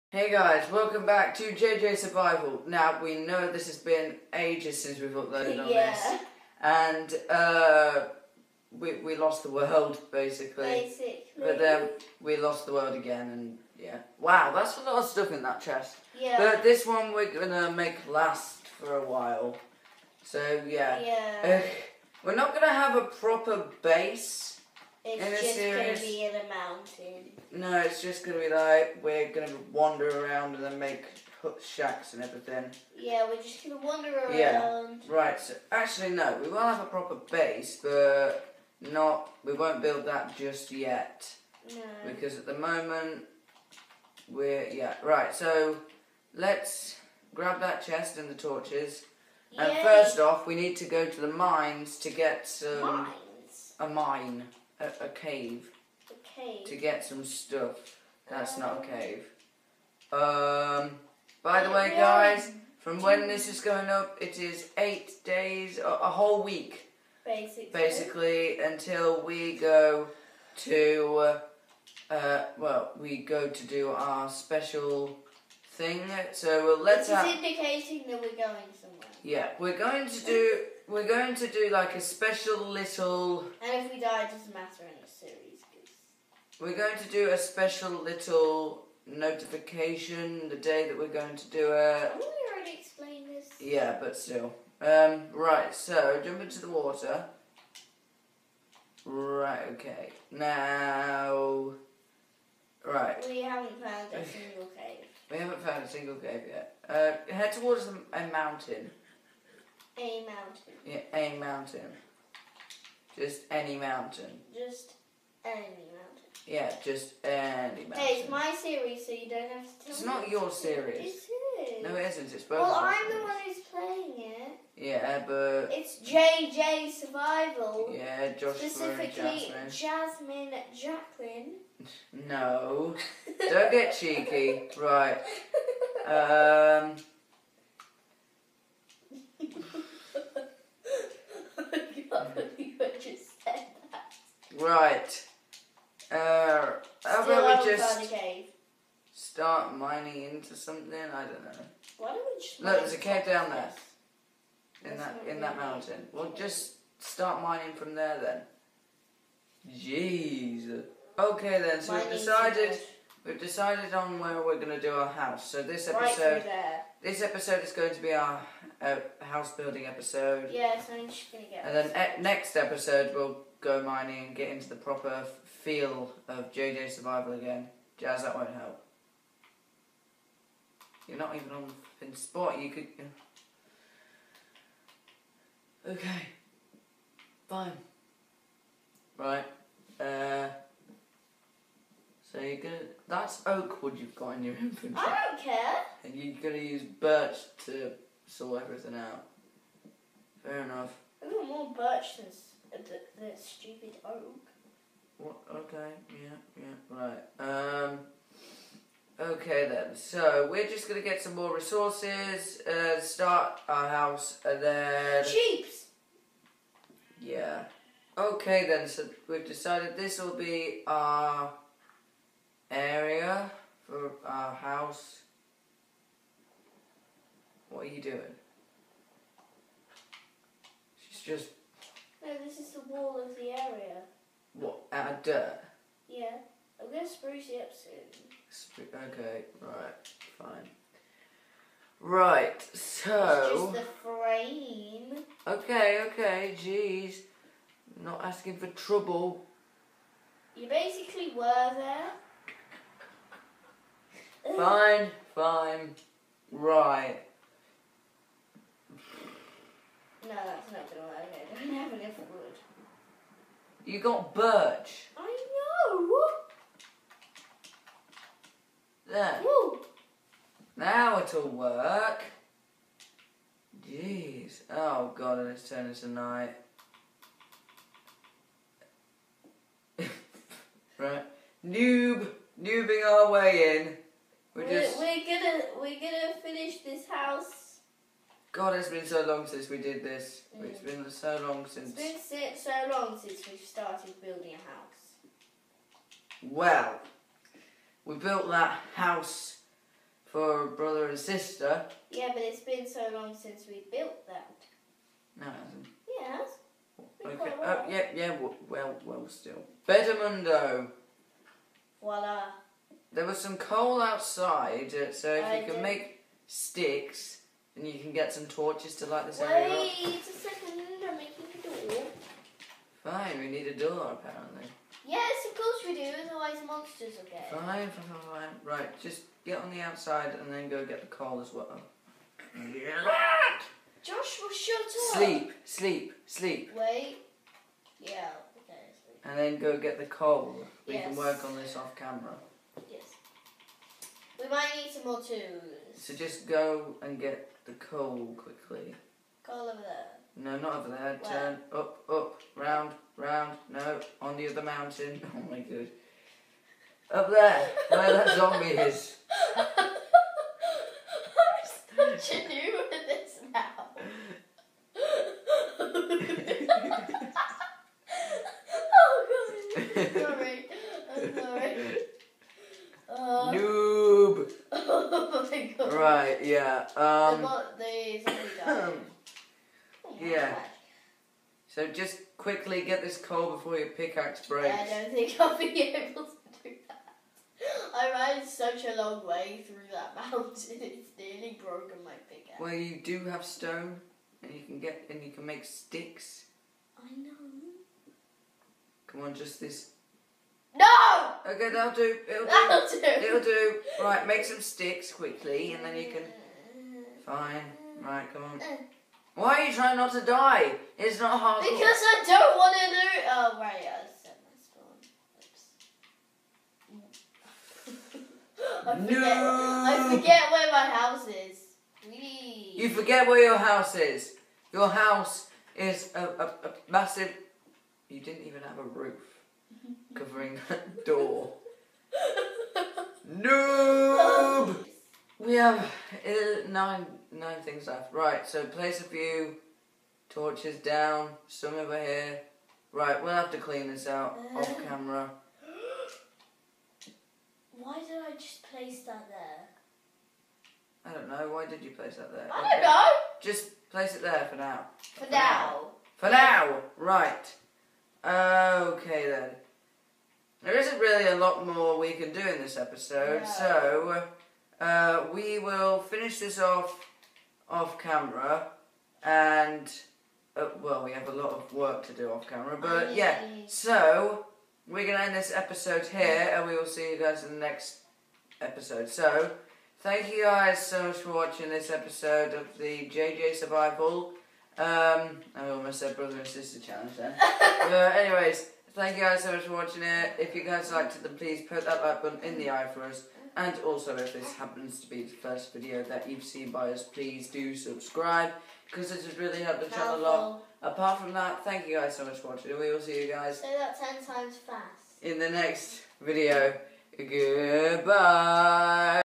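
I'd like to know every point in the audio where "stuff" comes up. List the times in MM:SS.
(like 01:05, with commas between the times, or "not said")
00:15, 00:57.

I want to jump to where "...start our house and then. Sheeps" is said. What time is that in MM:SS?
03:33.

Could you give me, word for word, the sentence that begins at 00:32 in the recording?
Yeah, we're just going to wander around.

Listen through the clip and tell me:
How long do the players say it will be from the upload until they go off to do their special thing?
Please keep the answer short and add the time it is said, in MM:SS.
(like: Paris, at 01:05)
8 days, at 01:04.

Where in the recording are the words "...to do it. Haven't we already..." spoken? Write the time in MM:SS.
01:31.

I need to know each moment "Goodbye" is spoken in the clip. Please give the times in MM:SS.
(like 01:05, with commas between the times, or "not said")
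08:27.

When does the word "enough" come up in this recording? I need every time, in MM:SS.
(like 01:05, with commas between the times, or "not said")
03:20, 04:21.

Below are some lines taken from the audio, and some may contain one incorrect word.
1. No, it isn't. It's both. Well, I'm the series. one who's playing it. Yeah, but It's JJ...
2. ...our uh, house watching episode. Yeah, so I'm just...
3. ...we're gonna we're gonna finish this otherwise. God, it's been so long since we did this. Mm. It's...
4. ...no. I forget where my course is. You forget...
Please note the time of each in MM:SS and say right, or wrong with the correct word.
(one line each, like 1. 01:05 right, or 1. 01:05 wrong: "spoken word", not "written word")
1. 02:01 right
2. 02:48 wrong: "building", not "watching"
3. 04:44 wrong: "house", not "otherwise"
4. 06:59 wrong: "house", not "course".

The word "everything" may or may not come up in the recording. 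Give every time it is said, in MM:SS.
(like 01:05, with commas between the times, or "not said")
00:32, 03:18.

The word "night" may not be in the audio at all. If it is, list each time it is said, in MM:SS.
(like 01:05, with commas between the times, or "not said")
04:36.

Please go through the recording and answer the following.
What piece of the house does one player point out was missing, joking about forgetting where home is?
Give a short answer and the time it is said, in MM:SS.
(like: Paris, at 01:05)
A roof, at 07:08.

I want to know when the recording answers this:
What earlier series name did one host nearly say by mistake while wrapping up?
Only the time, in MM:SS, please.
08:06.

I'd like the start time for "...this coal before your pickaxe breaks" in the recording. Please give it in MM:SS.
06:23.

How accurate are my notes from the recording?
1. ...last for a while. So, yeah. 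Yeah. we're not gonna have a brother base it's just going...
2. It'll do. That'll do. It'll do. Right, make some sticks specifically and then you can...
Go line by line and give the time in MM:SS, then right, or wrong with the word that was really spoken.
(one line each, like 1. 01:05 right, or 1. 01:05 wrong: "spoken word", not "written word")
1. 00:18 wrong: "proper", not "brother"
2. 06:42 wrong: "quickly", not "specifically".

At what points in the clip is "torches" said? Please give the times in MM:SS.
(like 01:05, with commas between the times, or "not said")
00:48, 05:18, 07:20.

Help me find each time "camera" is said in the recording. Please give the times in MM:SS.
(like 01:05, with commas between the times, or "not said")
05:41, 07:24, 07:47, 07:52.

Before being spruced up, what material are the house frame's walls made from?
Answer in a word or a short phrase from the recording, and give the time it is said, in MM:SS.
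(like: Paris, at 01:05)
Dirt, at 03:54.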